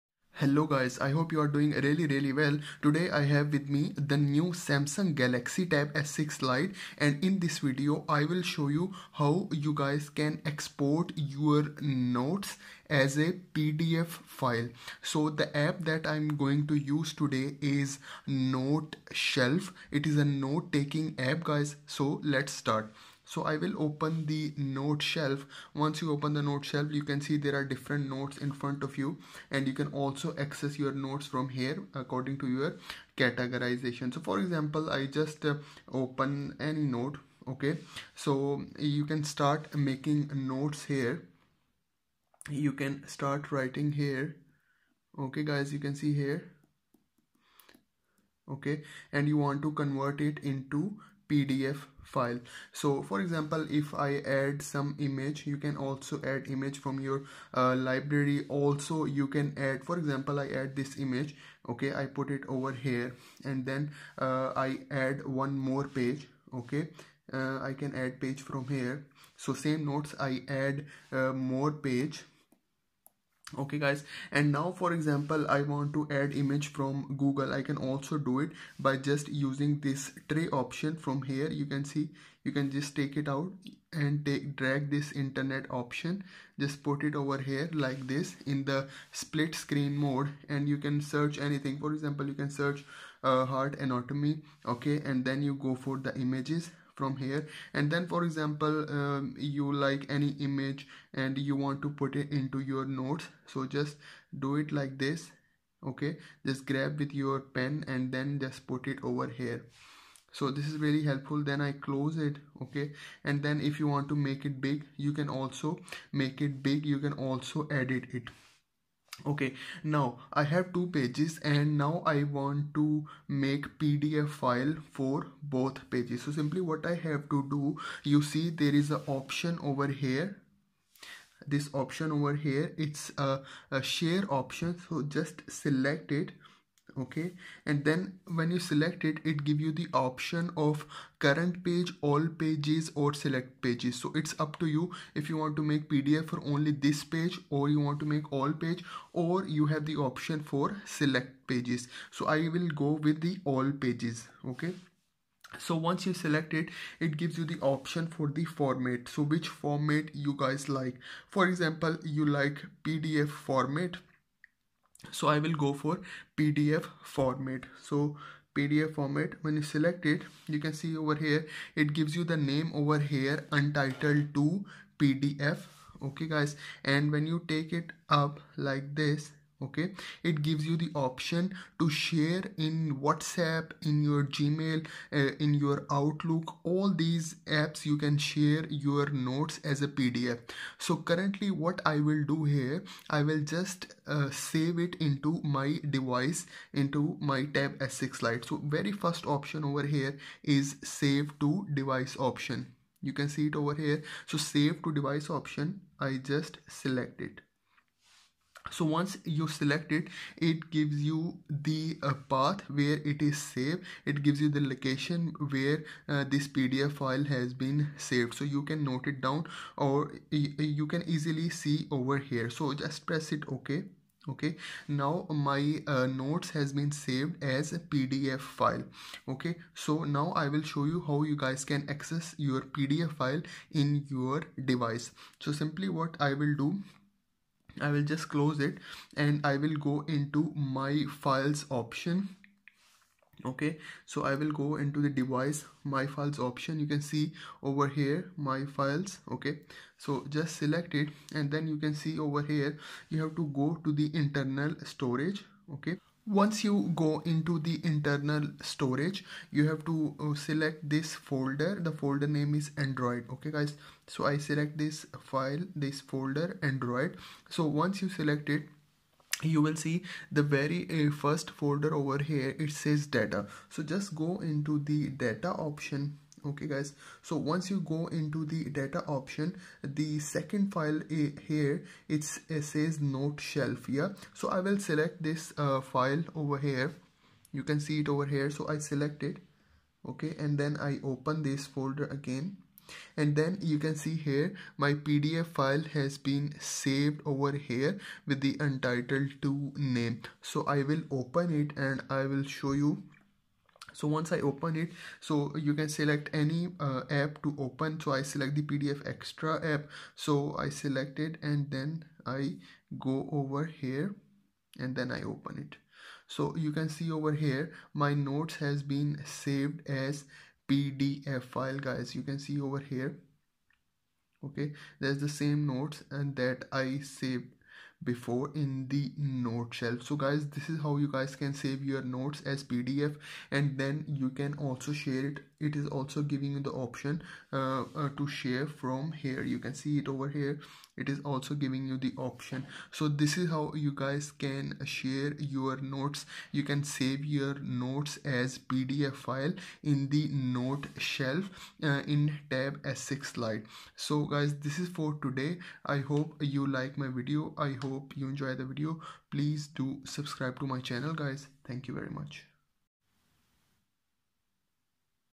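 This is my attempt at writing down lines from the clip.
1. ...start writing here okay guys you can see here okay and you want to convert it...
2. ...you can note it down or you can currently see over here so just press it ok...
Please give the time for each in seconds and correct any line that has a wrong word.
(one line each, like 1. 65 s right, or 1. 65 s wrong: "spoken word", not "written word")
1. 43 s right
2. 218 s wrong: "easily", not "currently".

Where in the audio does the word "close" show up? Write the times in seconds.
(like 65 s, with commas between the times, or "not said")
111 s, 238 s.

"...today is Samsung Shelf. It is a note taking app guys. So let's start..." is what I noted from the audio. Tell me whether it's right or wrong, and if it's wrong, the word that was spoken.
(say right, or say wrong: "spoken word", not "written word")
wrong: "Note", not "Samsung".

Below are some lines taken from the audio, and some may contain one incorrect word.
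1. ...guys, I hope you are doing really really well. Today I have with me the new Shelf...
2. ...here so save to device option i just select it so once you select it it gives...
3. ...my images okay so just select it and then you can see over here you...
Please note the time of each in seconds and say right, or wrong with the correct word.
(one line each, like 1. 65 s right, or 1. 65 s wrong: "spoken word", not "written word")
1. 0 s wrong: "Samsung", not "Shelf"
2. 203 s right
3. 248 s wrong: "files", not "images".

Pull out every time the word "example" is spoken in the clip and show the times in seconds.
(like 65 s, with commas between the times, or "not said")
34 s, 53 s, 59 s, 74 s, 91 s, 98 s, 161 s.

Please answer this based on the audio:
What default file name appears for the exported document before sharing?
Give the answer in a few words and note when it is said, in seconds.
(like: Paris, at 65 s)
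Untitled 2, at 173 s.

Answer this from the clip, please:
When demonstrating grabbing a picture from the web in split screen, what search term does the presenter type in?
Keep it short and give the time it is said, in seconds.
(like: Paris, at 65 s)
heart anatomy, at 93 s.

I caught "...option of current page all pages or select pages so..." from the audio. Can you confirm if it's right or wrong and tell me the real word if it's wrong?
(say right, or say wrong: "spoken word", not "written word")
right.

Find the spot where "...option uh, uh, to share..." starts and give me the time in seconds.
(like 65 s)
336 s.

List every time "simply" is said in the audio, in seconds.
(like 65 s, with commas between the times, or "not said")
126 s, 235 s.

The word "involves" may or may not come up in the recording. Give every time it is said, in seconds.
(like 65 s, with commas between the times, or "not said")
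not said.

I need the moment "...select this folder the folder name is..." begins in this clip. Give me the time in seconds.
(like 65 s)
260 s.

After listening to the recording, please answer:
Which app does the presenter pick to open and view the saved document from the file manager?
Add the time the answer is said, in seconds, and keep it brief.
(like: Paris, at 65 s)
PDF Extra, at 308 s.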